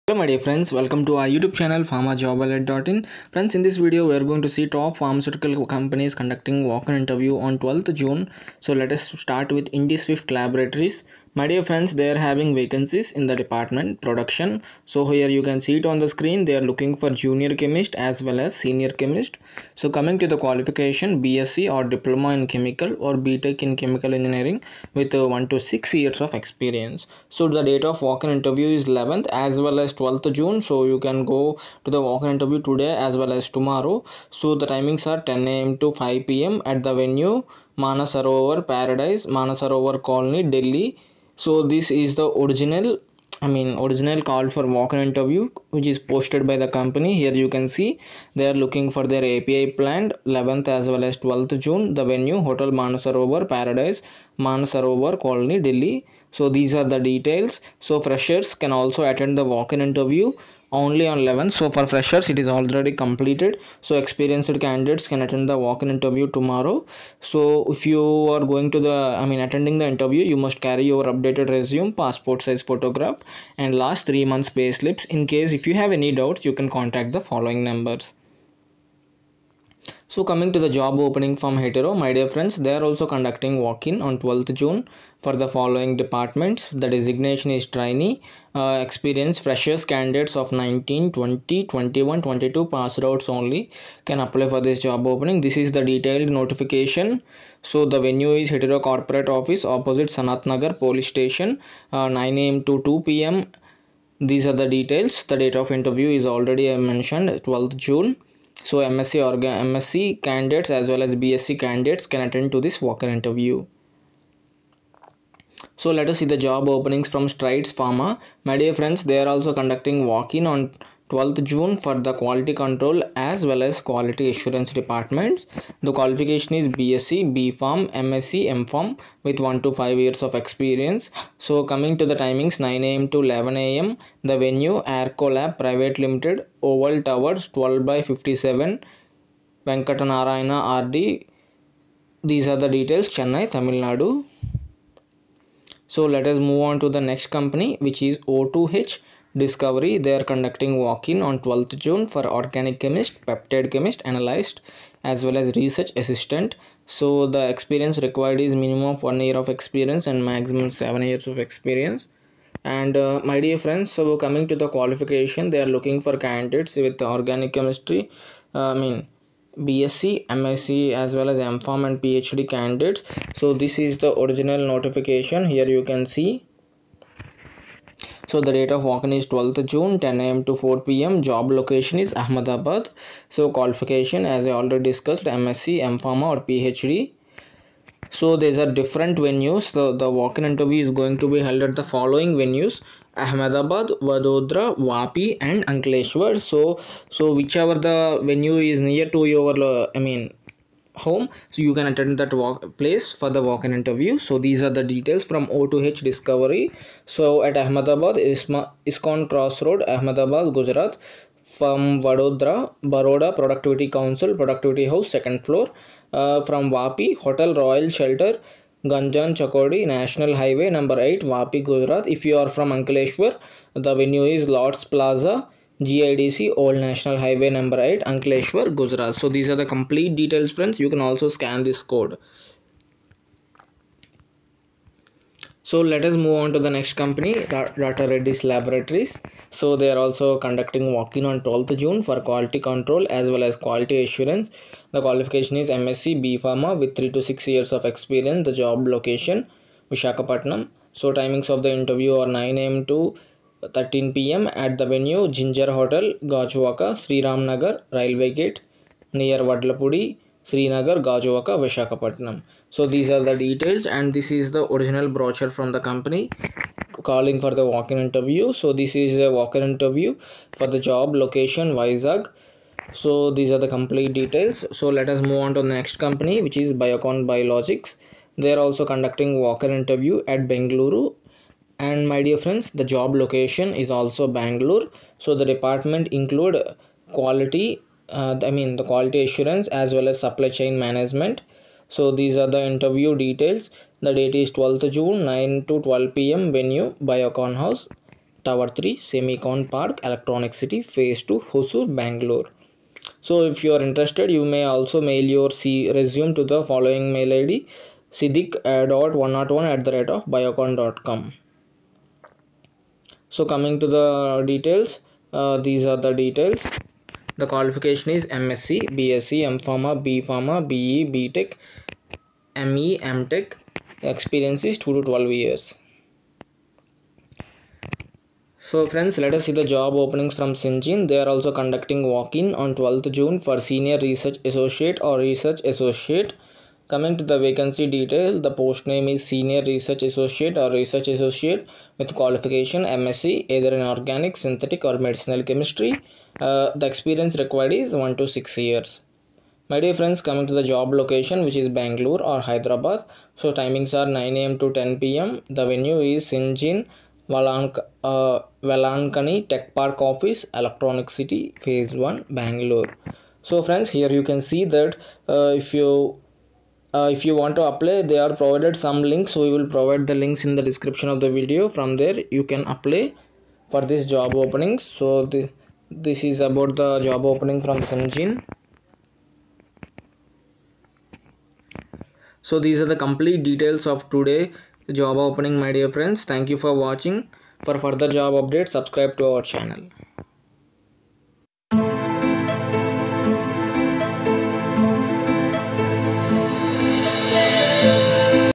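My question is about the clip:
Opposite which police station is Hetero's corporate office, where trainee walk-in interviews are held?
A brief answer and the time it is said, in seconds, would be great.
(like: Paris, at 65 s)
Sanat Nagar Police Station, at 100 s.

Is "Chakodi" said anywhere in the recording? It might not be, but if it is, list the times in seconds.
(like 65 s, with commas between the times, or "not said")
219 s.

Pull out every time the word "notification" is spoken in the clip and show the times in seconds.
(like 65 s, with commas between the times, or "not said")
96 s, 174 s.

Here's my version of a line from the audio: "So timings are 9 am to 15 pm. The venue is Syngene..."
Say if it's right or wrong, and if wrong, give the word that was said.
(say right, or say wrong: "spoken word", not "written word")
wrong: "10", not "15".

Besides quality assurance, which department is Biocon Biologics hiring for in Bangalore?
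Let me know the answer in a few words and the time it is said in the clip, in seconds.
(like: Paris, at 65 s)
Supply chain management, at 290 s.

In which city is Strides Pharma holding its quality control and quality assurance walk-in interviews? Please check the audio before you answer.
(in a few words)
Chennai.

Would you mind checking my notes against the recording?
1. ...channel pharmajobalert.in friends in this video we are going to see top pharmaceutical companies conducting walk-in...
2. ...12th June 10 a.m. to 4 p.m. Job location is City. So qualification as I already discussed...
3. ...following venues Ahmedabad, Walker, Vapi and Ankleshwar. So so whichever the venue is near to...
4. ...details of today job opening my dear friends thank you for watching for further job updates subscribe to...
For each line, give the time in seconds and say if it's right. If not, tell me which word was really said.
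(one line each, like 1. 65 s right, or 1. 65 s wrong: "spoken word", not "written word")
1. 1 s right
2. 179 s wrong: "Ahmedabad", not "City"
3. 191 s wrong: "Vadodara", not "Walker"
4. 383 s right.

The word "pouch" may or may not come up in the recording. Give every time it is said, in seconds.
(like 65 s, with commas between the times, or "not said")
not said.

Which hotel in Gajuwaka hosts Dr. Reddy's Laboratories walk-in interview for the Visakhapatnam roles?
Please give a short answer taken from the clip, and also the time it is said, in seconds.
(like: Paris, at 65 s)
Ginger Hotel, at 255 s.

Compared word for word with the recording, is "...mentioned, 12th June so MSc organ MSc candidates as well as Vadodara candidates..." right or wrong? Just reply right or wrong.
wrong.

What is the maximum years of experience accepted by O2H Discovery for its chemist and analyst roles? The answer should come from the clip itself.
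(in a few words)
7 years.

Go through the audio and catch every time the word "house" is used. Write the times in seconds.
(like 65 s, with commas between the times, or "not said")
214 s, 297 s.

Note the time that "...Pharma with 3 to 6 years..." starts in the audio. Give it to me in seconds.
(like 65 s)
246 s.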